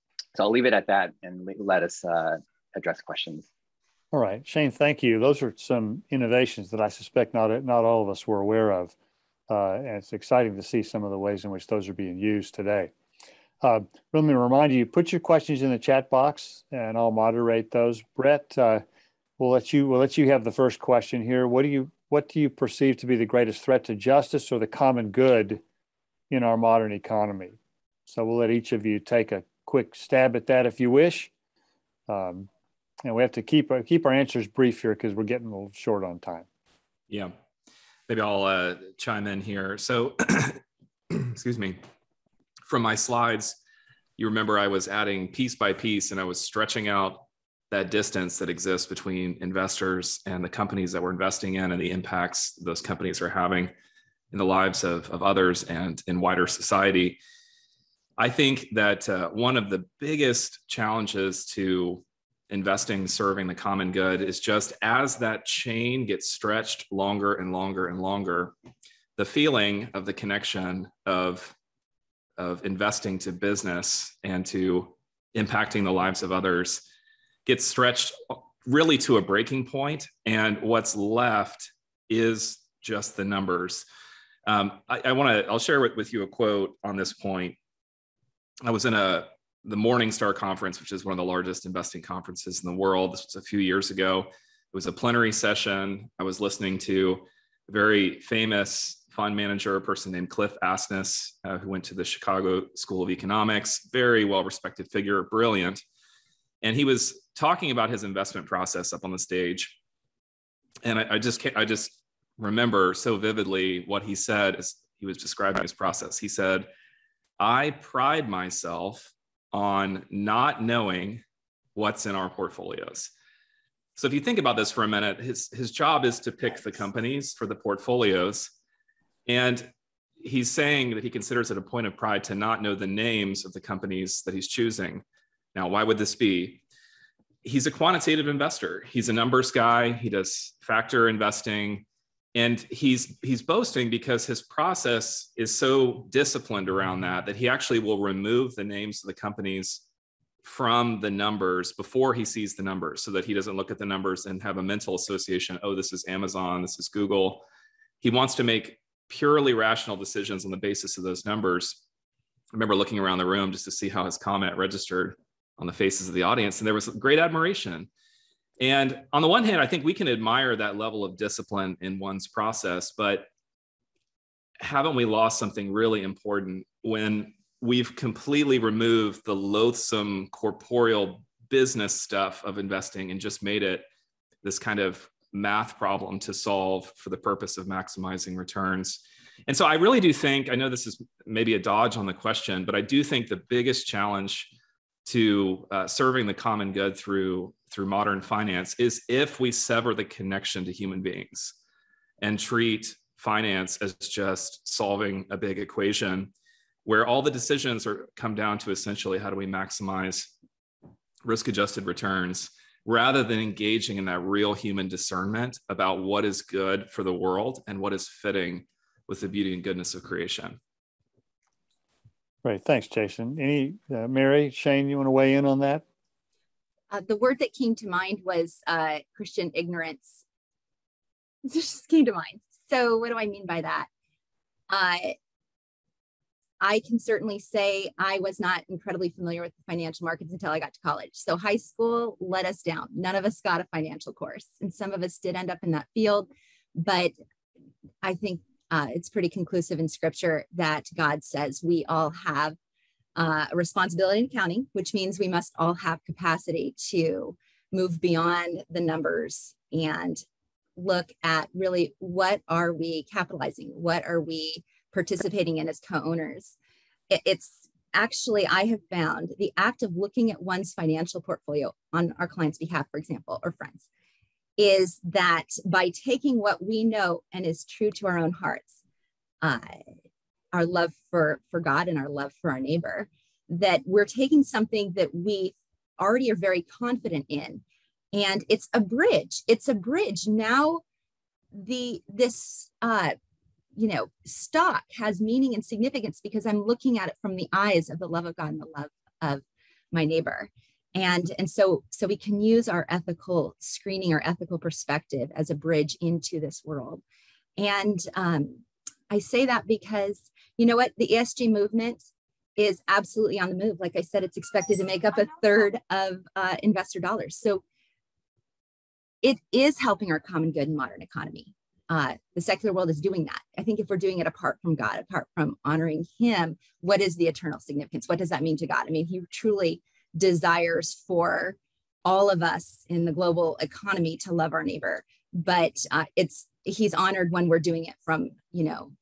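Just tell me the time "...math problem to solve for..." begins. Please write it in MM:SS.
03:05.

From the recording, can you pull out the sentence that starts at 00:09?
Uh, and it's exciting to see some of the ways in which those are being used today.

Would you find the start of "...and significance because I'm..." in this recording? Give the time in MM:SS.
04:55.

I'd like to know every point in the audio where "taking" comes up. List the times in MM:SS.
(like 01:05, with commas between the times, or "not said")
04:35, 04:44.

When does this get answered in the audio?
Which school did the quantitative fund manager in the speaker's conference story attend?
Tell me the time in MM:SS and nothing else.
01:42.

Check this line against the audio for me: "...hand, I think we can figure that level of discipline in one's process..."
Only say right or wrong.
wrong.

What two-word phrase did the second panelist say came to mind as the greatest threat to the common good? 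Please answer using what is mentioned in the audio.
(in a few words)
Christian ignorance.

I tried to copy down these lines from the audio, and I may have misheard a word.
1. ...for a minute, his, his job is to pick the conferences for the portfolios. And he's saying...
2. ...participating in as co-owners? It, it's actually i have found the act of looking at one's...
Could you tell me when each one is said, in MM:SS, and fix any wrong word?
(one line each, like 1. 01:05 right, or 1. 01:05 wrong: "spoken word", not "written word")
1. 02:04 wrong: "companies", not "conferences"
2. 04:24 right.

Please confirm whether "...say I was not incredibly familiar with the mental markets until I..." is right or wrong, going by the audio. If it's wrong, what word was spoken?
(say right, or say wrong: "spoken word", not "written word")
wrong: "financial", not "mental".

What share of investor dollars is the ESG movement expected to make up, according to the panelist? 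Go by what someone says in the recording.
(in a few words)
a third.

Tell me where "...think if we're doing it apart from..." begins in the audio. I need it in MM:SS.
05:23.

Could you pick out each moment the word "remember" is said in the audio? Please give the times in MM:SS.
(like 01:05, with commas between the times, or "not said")
00:44, 01:52, 02:42.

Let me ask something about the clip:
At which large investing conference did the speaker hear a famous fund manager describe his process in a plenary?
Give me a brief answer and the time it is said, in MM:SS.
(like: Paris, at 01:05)
Morningstar Conference, at 01:29.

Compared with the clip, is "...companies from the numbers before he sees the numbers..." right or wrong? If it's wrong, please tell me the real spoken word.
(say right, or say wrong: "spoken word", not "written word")
right.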